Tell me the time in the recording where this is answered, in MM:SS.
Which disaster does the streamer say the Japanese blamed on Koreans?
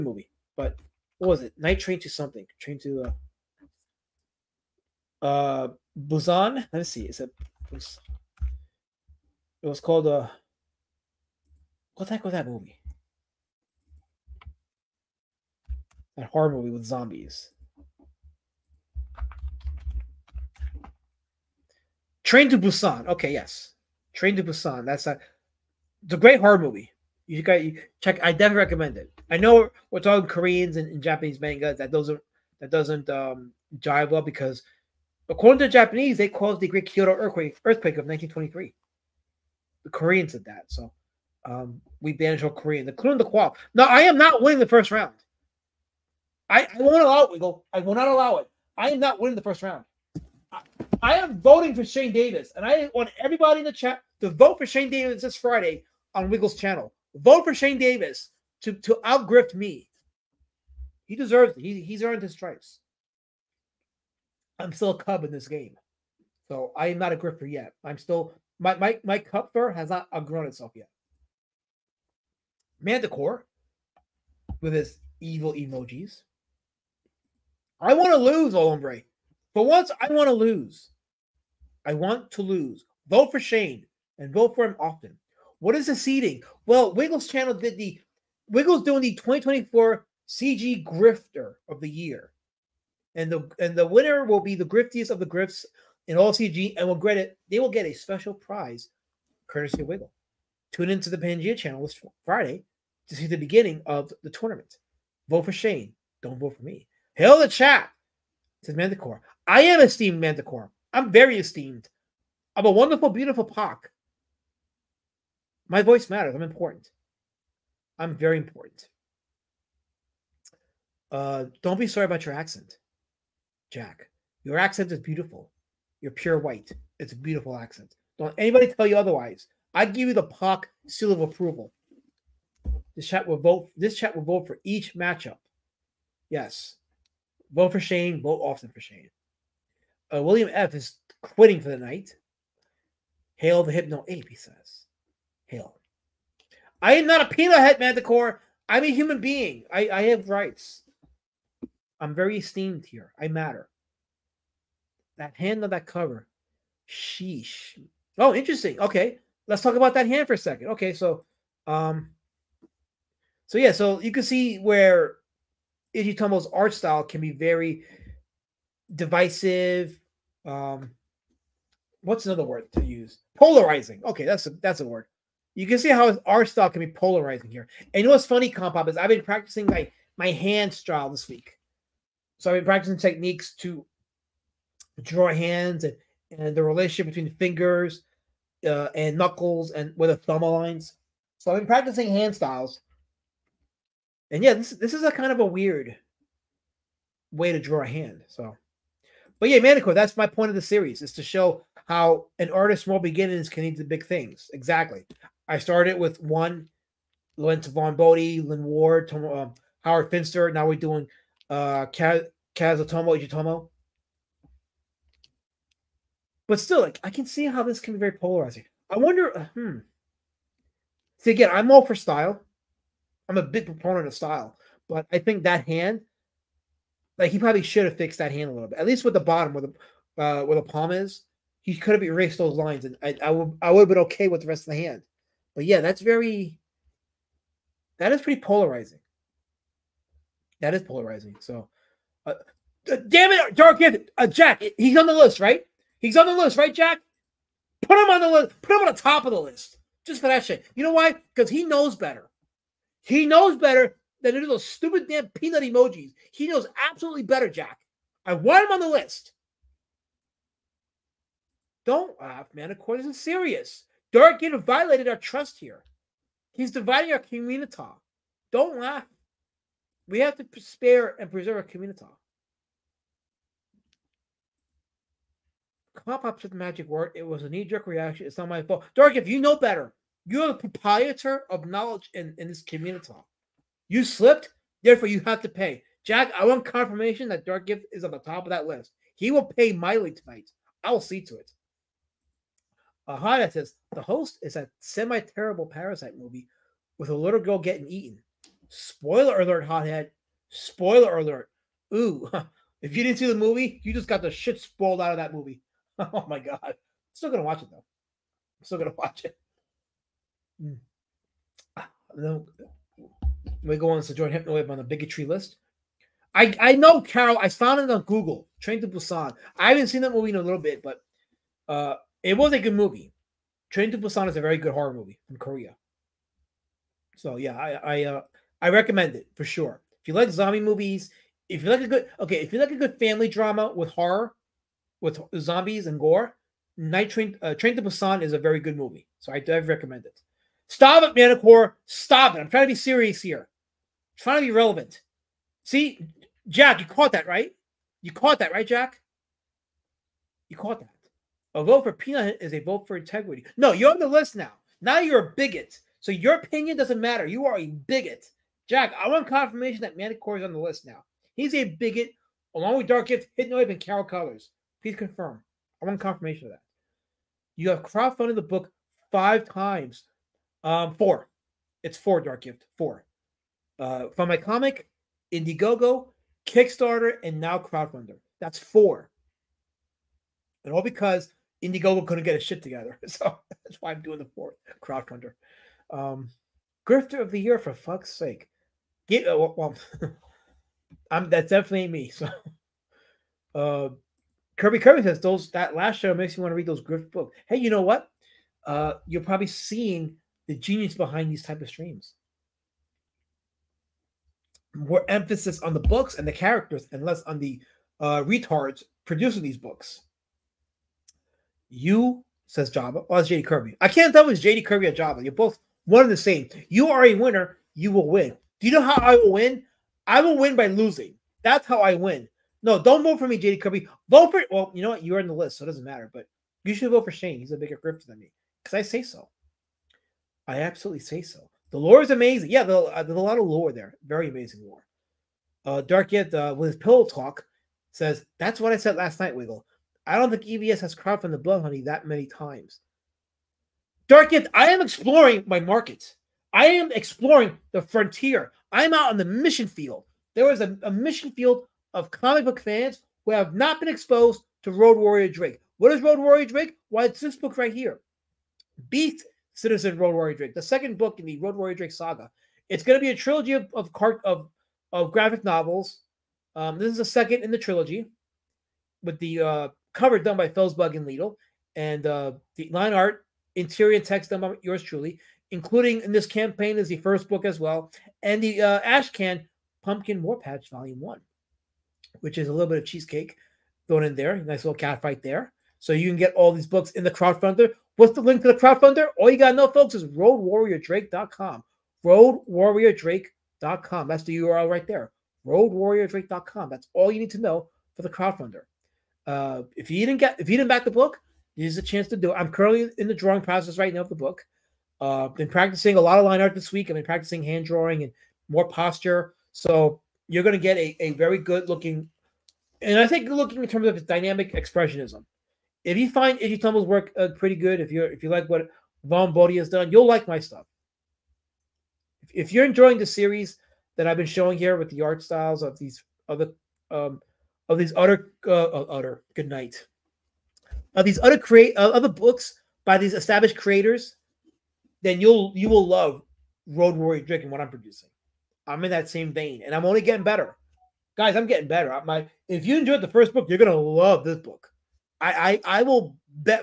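00:36.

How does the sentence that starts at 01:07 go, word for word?
I'm still my my my cup fur has not outgrown itself yet.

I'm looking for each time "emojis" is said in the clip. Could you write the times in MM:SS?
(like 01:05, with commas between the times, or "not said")
01:15, 04:15.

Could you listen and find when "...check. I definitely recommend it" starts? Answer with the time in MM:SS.
00:28.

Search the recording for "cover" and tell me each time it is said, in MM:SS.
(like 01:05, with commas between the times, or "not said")
02:35, 07:49.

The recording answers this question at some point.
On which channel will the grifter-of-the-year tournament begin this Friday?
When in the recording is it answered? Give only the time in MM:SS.
01:41.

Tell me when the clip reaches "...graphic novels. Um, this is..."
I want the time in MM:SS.
07:45.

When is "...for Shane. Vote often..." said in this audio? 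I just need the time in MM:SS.
02:17.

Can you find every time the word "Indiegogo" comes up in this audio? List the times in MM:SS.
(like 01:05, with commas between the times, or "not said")
06:15, 06:21.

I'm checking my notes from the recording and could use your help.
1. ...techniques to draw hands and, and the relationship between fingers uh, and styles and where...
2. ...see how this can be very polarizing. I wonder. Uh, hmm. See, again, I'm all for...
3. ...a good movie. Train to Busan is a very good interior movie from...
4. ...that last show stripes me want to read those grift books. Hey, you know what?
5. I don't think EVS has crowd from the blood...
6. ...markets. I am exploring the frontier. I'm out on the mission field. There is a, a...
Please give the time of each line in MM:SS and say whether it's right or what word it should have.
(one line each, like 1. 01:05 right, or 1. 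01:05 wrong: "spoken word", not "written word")
1. 03:02 wrong: "knuckles", not "styles"
2. 03:37 right
3. 05:22 wrong: "horror", not "interior"
4. 06:35 wrong: "makes", not "stripes"
5. 07:20 right
6. 07:25 right.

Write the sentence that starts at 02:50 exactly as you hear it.
Um what's another word to use?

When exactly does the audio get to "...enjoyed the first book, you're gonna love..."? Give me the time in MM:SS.
09:02.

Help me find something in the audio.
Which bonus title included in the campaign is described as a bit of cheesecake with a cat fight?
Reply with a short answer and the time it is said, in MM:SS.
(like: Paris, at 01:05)
Pumpkin War Patch Volume 1, at 07:59.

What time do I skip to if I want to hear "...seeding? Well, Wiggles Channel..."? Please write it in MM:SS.
01:25.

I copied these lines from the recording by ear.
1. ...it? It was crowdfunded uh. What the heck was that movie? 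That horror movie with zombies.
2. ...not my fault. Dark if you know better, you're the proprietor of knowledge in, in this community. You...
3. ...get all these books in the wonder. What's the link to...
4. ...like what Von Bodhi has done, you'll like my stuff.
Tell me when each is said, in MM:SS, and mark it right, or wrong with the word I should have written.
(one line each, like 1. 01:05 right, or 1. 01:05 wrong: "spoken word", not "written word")
1. 00:07 wrong: "called", not "crowdfunded"
2. 04:38 right
3. 08:06 wrong: "crowdfunder", not "wonder"
4. 08:38 right.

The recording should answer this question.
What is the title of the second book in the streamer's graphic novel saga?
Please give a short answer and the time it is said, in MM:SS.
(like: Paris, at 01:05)
Beat Citizen, at 07:38.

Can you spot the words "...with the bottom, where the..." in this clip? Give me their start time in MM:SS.
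03:49.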